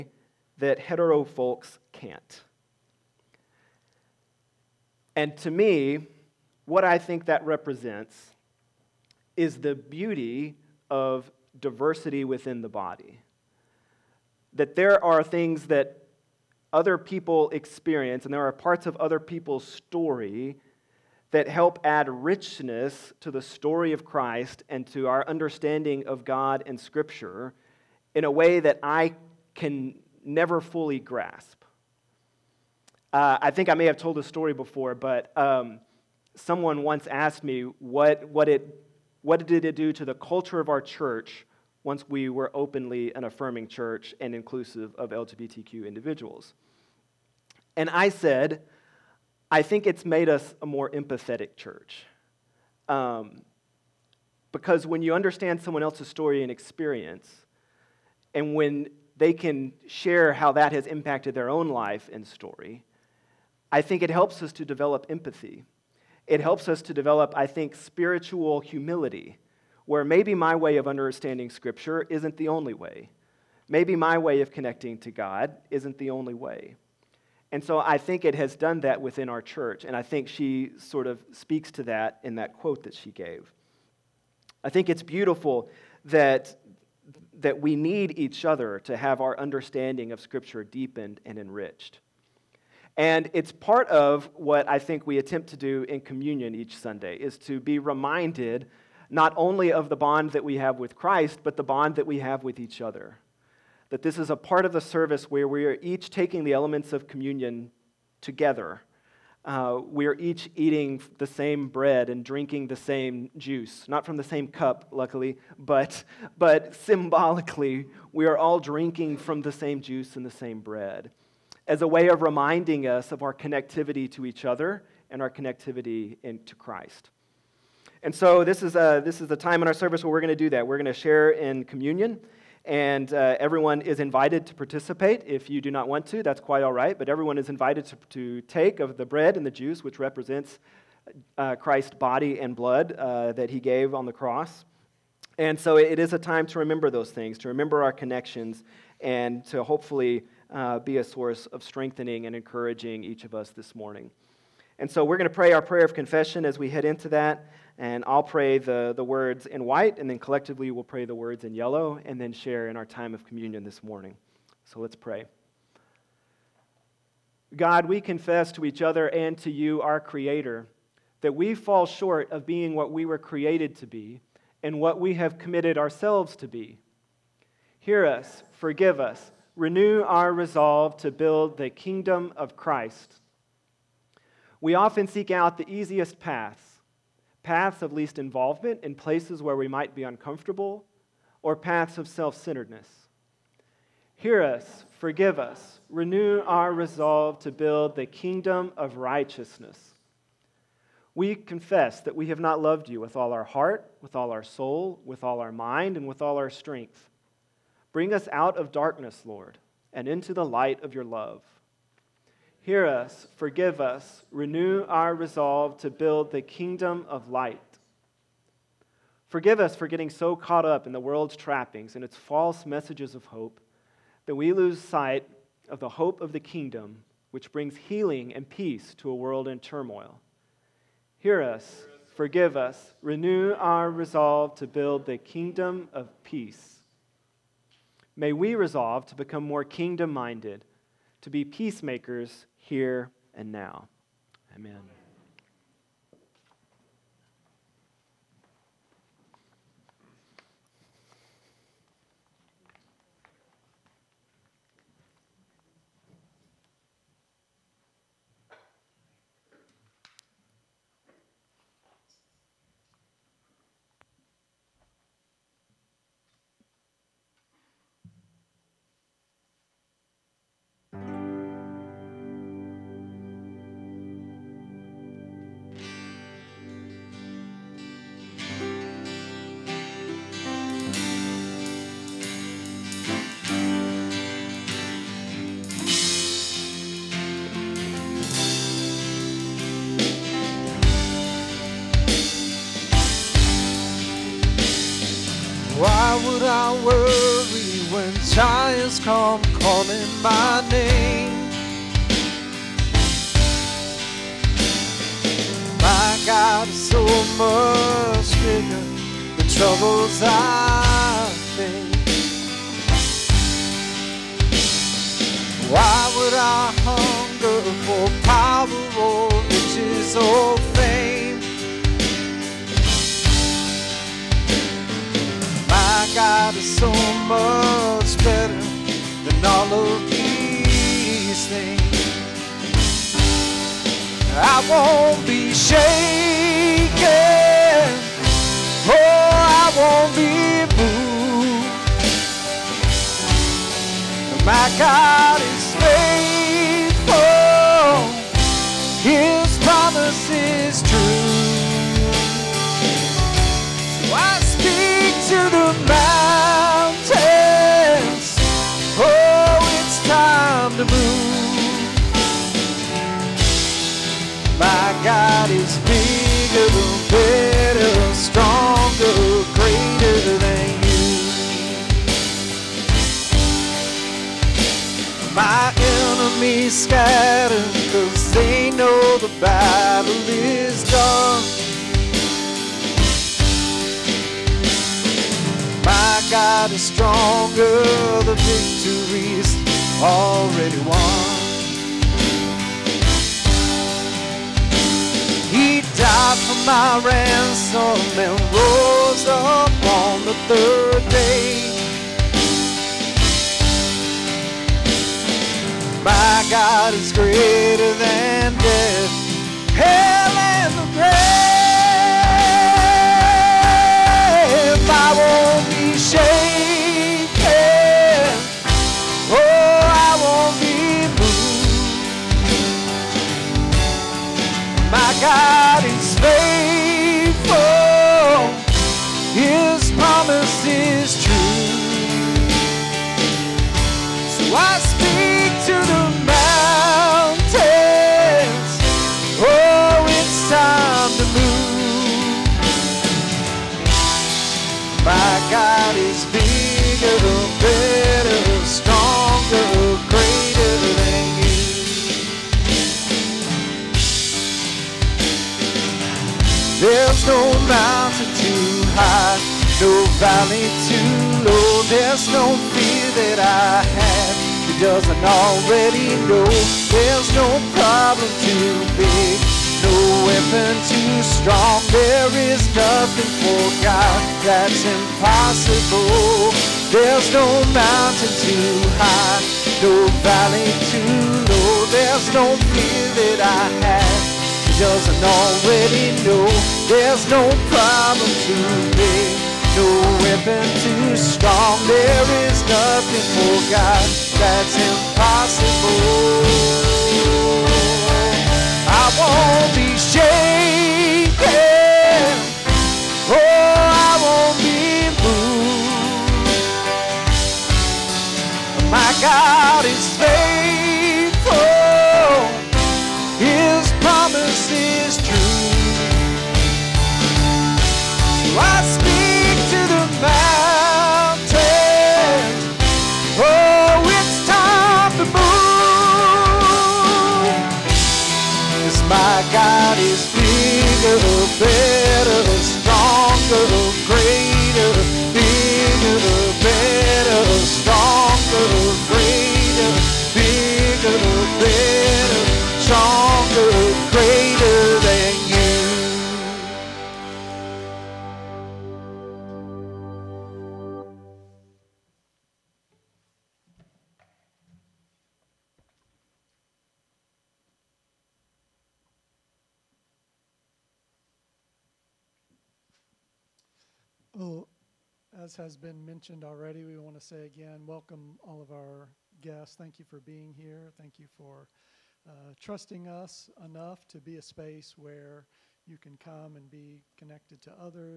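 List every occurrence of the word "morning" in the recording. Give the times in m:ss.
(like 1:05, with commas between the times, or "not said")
2:33, 2:43.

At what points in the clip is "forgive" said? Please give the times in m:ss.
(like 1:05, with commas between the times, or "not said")
2:58, 3:14, 3:33, 3:39, 3:52.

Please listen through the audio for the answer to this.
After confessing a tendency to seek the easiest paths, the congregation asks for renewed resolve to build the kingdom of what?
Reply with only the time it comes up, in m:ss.
3:18.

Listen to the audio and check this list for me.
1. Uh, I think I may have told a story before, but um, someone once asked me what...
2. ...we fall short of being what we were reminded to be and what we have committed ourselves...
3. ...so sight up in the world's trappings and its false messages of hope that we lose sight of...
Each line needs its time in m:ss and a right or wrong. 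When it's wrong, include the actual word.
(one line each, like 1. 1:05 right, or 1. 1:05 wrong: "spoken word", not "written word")
1. 0:33 right
2. 2:51 wrong: "created", not "reminded"
3. 3:40 wrong: "caught", not "sight".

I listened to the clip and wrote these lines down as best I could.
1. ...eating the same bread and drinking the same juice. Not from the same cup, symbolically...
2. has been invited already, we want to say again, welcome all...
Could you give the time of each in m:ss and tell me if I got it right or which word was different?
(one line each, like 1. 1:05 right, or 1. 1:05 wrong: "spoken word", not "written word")
1. 1:50 wrong: "luckily", not "symbolically"
2. 9:25 wrong: "mentioned", not "invited".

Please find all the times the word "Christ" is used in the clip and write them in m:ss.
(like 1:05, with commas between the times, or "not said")
0:24, 1:40, 2:06, 2:21, 3:02.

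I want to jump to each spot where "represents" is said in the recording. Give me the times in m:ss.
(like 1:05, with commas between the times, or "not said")
0:07, 2:20.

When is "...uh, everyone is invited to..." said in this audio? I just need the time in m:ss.
2:13.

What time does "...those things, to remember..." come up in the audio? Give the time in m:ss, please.
2:26.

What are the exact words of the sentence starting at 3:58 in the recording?
May we resolve to become more kingdom minded, to be peacemakers here and now.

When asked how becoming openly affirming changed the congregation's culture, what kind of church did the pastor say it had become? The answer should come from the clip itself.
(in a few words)
More empathetic.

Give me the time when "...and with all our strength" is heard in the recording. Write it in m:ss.
3:25.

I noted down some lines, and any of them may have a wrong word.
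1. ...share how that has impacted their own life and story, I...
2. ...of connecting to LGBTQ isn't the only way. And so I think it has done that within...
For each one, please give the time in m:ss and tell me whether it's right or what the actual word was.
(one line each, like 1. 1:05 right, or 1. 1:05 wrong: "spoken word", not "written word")
1. 0:59 right
2. 1:14 wrong: "God", not "LGBTQ".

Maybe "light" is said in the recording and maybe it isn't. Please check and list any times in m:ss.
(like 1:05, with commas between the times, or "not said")
3:30, 3:37.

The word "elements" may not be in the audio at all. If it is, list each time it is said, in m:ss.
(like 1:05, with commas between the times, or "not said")
1:46.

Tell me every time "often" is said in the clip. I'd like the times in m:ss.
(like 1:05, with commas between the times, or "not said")
3:04.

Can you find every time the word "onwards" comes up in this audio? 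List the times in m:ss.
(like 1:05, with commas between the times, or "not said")
not said.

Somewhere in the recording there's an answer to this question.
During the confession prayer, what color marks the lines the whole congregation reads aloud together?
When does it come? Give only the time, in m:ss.
2:41.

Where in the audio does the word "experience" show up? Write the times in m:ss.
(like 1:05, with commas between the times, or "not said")
0:17, 0:56.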